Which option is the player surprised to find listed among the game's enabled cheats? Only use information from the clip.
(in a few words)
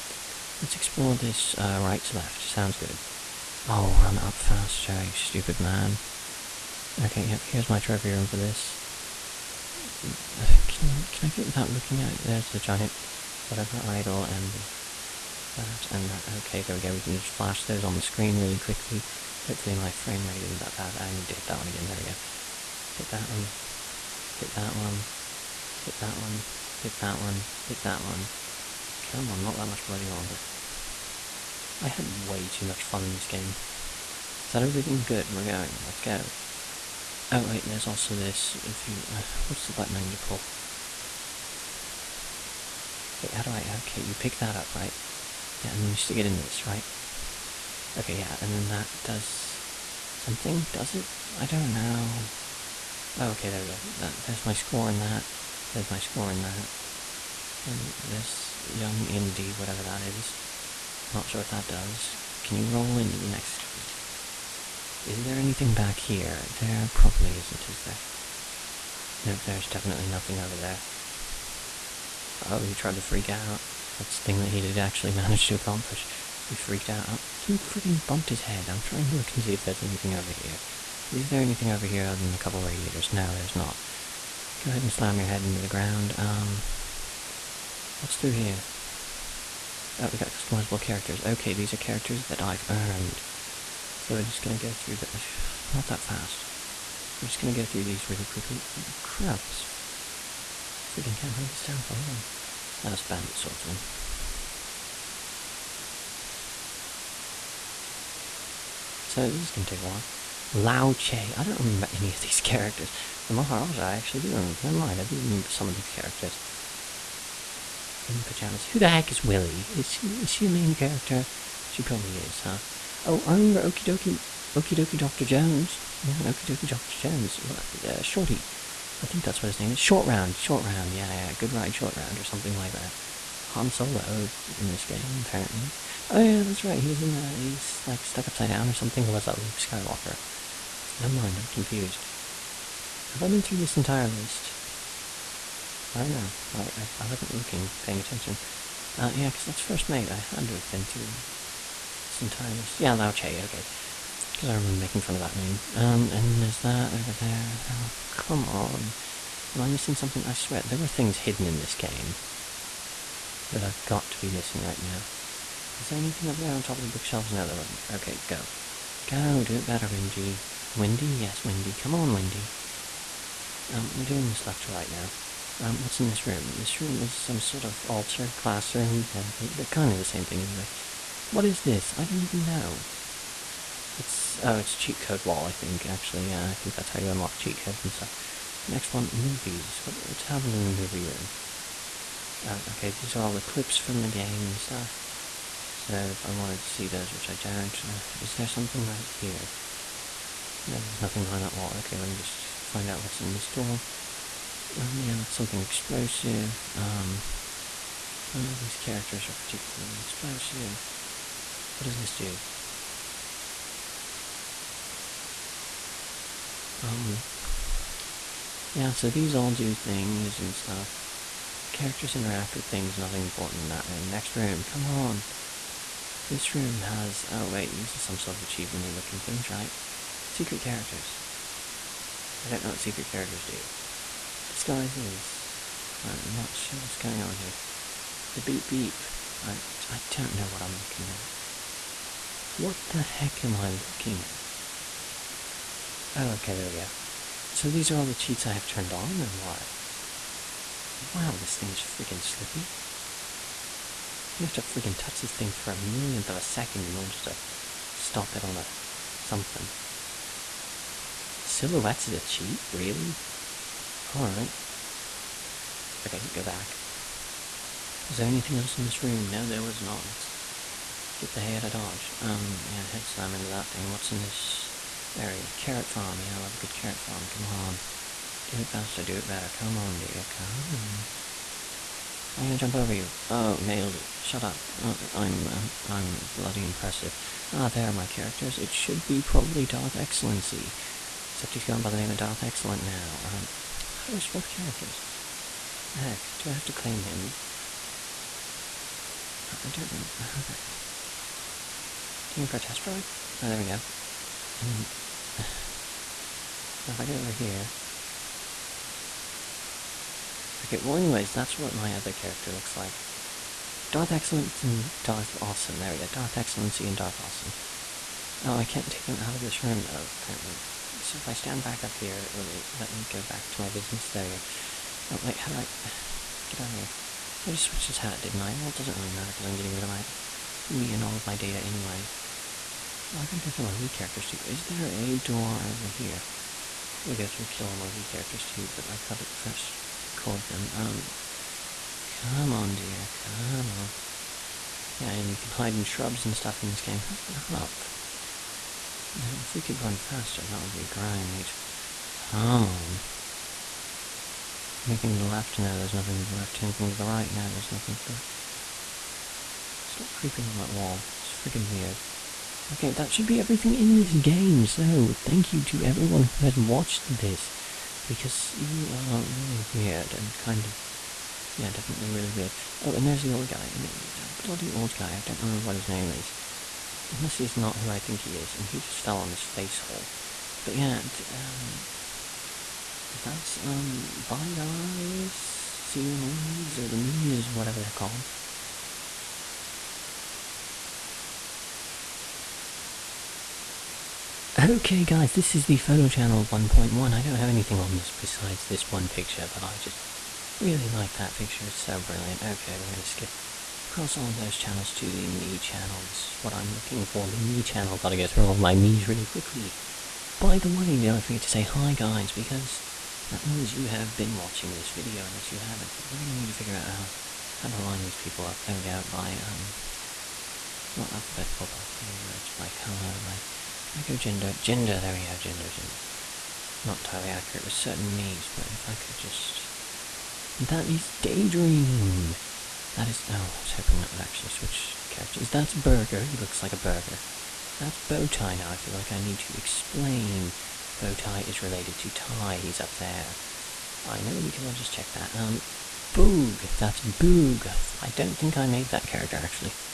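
Silhouettes.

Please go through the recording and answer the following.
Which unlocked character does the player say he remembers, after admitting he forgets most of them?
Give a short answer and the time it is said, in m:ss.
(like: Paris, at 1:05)
The Maharaja, at 1:53.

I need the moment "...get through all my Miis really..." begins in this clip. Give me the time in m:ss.
6:48.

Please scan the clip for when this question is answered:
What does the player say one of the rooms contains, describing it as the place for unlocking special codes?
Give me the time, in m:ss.
3:04.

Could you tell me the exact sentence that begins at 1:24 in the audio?
Go ahead and slam your head into the ground.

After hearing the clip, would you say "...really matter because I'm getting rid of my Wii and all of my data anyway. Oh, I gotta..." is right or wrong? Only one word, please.
right.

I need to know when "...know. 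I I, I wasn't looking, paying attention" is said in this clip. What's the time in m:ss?
2:26.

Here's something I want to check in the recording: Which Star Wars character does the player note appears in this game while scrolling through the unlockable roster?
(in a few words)
Han Solo.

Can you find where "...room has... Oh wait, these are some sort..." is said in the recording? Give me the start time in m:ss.
3:46.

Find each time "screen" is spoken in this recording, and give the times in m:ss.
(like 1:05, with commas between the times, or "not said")
0:18, 1:03.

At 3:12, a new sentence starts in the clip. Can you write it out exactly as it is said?
Oh, okay, these are all the clips from the game and stuff.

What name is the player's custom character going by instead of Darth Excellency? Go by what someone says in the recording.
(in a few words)
Darth Excellent.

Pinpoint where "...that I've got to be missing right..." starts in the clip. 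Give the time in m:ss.
2:43.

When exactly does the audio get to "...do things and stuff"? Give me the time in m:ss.
3:39.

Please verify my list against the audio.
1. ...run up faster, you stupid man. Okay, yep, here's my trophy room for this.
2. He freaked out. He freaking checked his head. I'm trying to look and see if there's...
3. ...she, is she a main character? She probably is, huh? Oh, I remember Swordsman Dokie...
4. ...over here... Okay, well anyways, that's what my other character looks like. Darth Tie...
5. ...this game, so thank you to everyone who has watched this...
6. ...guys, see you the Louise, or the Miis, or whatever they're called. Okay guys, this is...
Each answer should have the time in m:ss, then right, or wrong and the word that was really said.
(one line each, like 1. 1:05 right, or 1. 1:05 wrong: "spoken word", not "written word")
1. 0:04 right
2. 1:16 wrong: "bumped", not "checked"
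3. 1:59 wrong: "Okey", not "Swordsman"
4. 5:07 wrong: "Excellence", not "Tie"
5. 6:03 right
6. 6:24 right.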